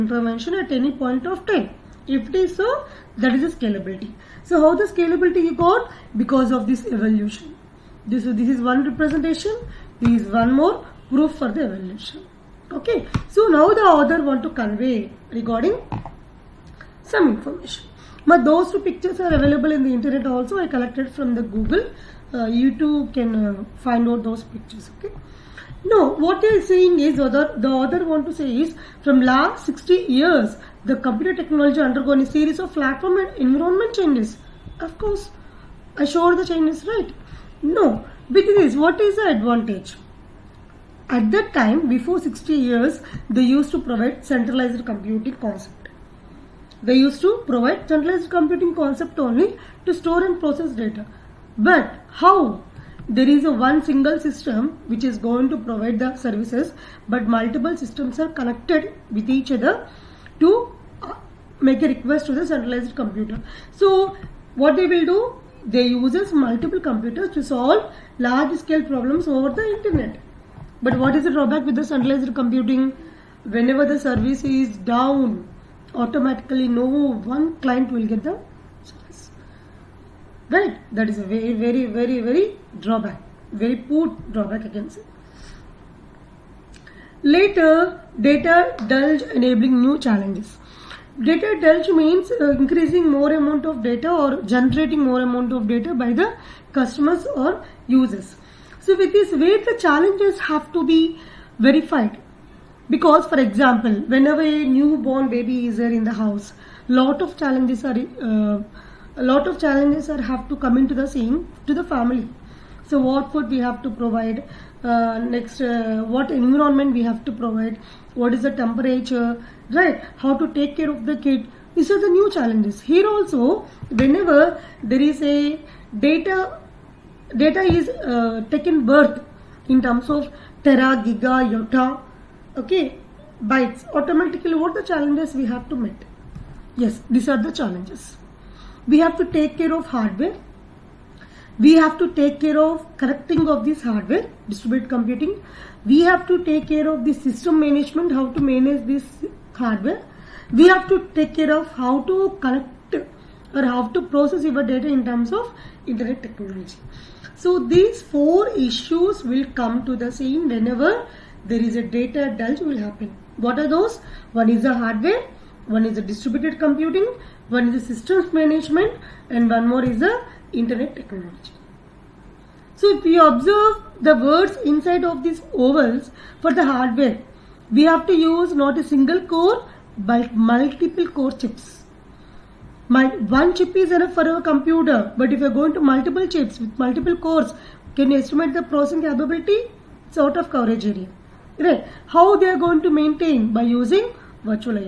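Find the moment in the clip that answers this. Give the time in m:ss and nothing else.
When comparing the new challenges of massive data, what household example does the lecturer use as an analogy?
1:44.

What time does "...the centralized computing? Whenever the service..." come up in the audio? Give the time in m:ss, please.
1:11.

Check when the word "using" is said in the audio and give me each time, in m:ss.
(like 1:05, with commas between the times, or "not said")
3:13.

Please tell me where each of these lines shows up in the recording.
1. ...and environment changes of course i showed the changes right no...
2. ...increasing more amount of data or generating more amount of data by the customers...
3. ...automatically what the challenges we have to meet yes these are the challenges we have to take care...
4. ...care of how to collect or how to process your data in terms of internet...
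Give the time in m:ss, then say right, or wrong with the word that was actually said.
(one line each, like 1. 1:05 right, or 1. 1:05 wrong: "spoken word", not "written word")
1. 0:33 right
2. 1:32 right
3. 2:14 right
4. 2:31 right.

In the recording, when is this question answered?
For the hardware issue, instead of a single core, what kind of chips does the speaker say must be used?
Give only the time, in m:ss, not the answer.
3:00.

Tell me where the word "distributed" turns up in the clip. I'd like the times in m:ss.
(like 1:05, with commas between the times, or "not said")
2:24, 2:46.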